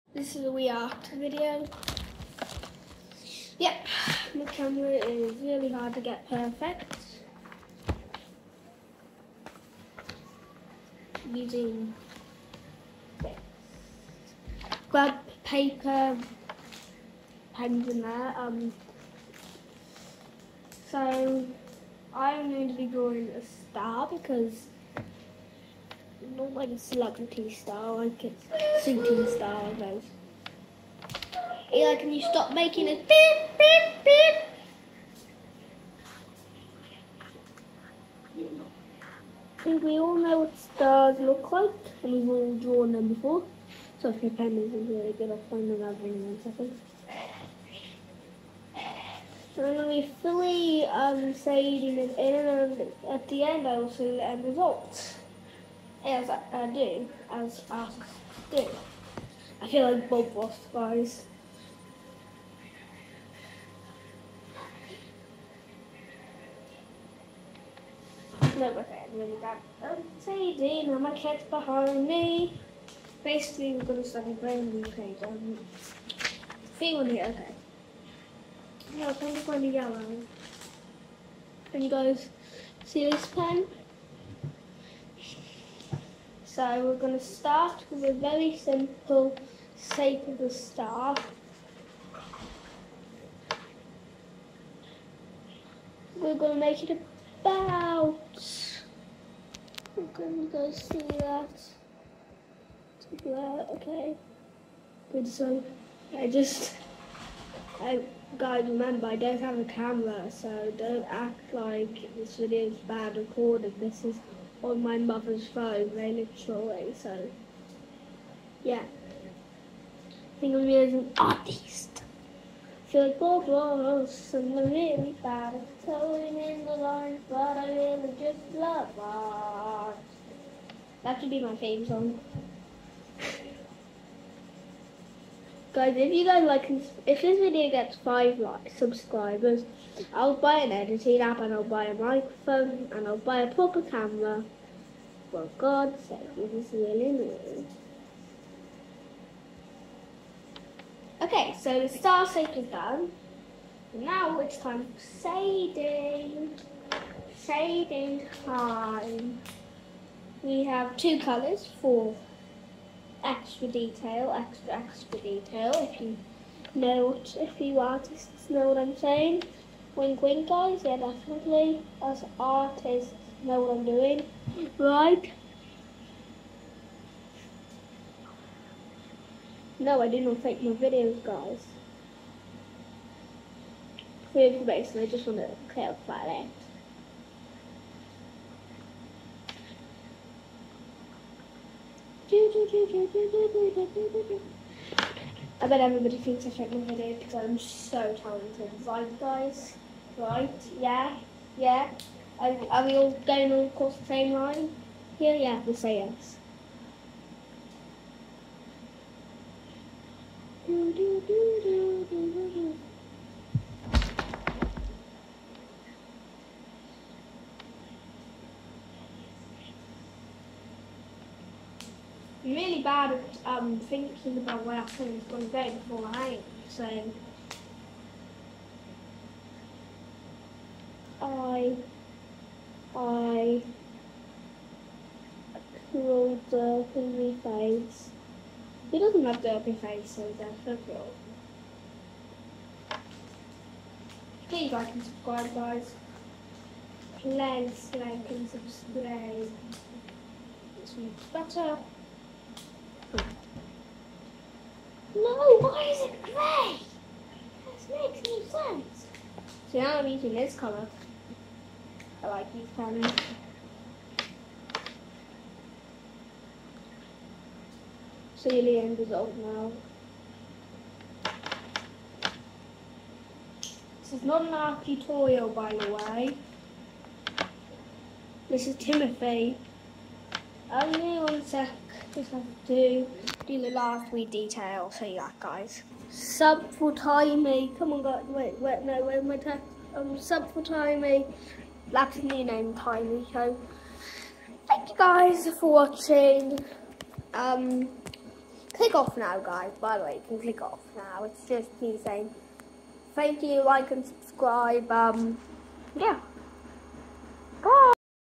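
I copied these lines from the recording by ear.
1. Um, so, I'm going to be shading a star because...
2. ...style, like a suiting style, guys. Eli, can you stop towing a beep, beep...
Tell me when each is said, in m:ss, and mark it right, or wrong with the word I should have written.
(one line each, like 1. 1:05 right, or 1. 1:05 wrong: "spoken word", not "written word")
1. 0:18 wrong: "drawing", not "shading"
2. 0:27 wrong: "making", not "towing".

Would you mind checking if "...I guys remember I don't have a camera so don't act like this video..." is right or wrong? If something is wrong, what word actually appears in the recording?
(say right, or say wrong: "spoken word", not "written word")
right.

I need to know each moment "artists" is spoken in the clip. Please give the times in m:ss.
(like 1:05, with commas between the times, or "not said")
2:01, 2:47, 2:52.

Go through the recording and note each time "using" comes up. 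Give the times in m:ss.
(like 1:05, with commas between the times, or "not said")
0:11, 4:20.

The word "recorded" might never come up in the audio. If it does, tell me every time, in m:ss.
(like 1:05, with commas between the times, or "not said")
1:53.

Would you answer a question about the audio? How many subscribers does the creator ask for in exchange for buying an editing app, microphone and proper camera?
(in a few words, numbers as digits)
5.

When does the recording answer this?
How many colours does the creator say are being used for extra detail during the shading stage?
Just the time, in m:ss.
2:40.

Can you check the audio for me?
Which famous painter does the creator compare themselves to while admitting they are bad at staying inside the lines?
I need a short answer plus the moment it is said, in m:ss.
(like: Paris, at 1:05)
Bob Ross, at 2:03.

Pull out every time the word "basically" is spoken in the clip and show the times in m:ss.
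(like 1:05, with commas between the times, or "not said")
1:13, 3:04.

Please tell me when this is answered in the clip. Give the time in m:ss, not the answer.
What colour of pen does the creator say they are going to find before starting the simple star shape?
1:19.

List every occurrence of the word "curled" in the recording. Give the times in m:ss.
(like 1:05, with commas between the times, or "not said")
3:55.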